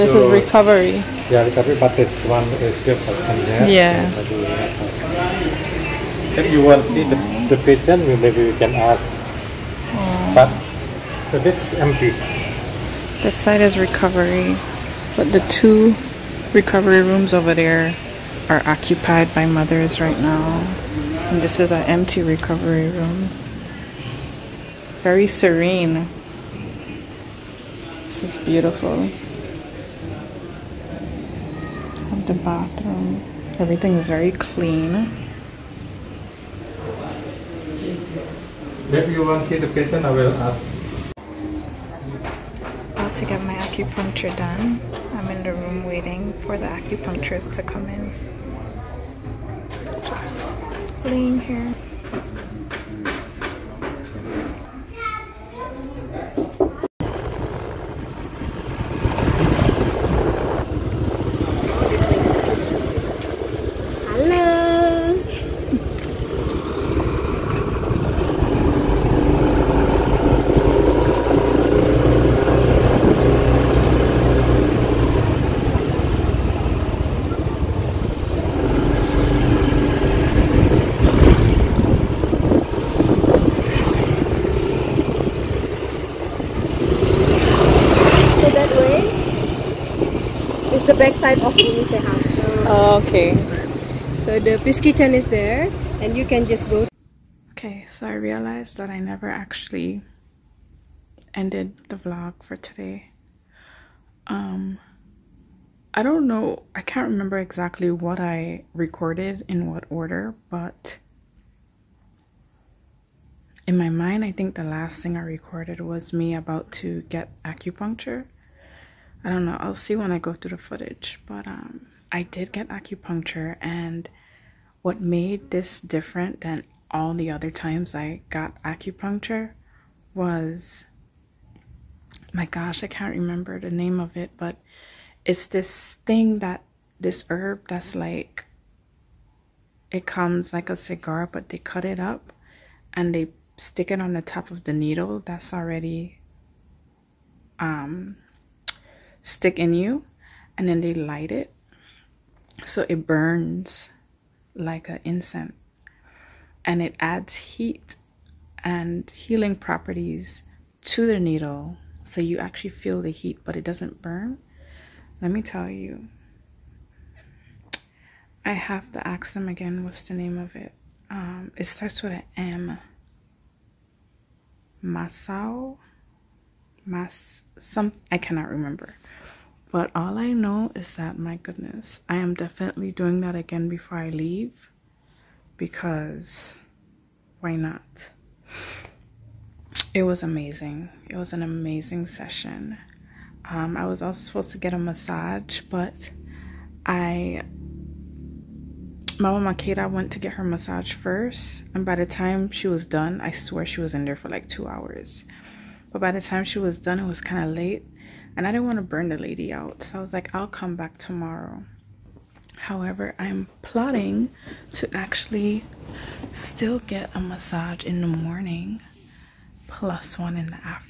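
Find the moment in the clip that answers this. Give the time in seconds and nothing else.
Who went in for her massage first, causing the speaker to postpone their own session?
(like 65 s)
199 s.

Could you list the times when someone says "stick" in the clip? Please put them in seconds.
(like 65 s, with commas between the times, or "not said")
143 s, 149 s.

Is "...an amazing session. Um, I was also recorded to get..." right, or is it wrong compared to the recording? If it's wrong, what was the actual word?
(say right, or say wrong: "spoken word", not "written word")
wrong: "supposed", not "recorded".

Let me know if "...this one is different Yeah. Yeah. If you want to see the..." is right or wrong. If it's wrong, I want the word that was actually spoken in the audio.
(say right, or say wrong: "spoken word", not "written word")
right.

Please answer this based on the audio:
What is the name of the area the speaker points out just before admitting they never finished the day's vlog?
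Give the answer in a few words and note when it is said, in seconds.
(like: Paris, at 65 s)
Peace Kitchen, at 94 s.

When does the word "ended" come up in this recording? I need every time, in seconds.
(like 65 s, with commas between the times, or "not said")
101 s.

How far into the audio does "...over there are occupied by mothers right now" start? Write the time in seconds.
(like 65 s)
17 s.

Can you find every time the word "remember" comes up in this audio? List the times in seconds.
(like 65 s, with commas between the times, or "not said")
107 s, 133 s, 178 s.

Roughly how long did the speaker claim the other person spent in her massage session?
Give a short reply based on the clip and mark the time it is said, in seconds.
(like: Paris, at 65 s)
2 hours, at 204 s.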